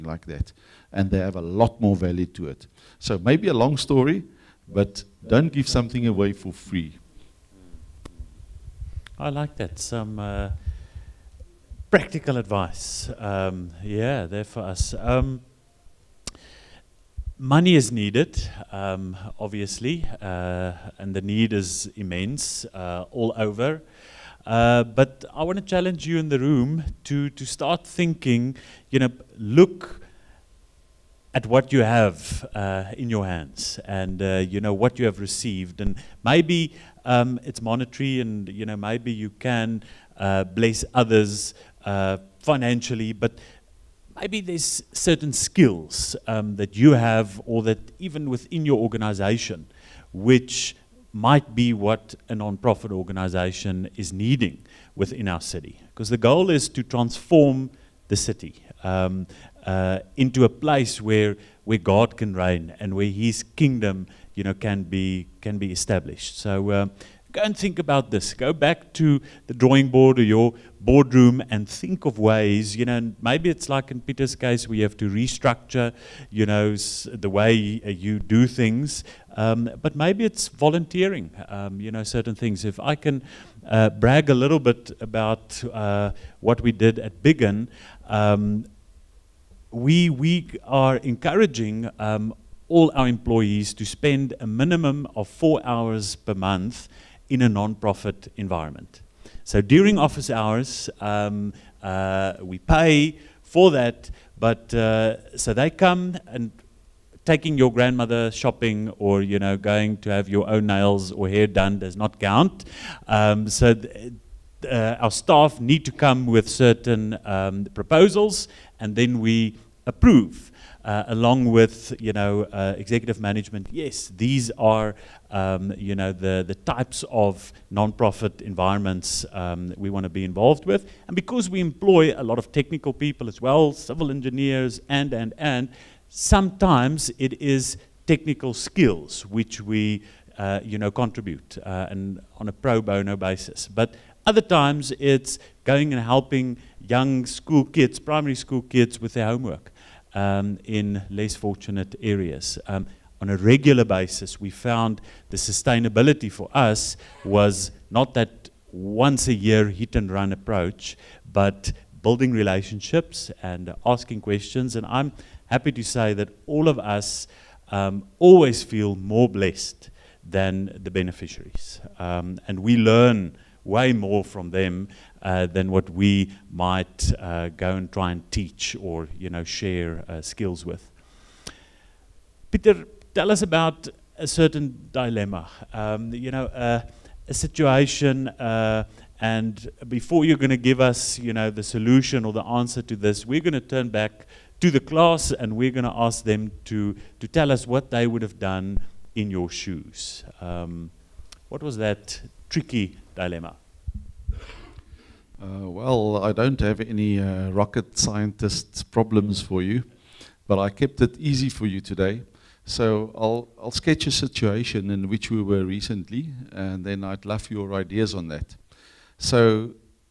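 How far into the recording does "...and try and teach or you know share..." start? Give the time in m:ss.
2:57.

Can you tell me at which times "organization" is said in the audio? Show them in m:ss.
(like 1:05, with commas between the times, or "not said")
0:48, 0:52.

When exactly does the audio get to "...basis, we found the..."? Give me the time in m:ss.
2:33.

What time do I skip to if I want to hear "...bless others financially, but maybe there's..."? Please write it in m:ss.
0:40.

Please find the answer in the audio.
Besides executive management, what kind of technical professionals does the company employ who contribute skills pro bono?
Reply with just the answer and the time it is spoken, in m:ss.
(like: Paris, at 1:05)
Civil engineers, at 2:13.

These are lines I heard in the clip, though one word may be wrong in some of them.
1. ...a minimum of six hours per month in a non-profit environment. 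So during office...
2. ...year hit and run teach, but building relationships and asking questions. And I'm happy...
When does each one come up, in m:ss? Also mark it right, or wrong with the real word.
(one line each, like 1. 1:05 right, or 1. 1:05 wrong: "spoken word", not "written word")
1. 1:34 wrong: "four", not "six"
2. 2:39 wrong: "approach", not "teach".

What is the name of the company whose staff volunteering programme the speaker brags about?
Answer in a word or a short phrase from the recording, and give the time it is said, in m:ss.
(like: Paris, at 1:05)
Biggin, at 1:27.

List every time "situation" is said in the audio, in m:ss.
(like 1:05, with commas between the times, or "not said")
3:07, 3:34.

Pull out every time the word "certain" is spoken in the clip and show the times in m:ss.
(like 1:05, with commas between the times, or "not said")
0:44, 1:22, 1:56, 3:04.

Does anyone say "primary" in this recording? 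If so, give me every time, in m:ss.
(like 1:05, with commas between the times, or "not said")
2:27.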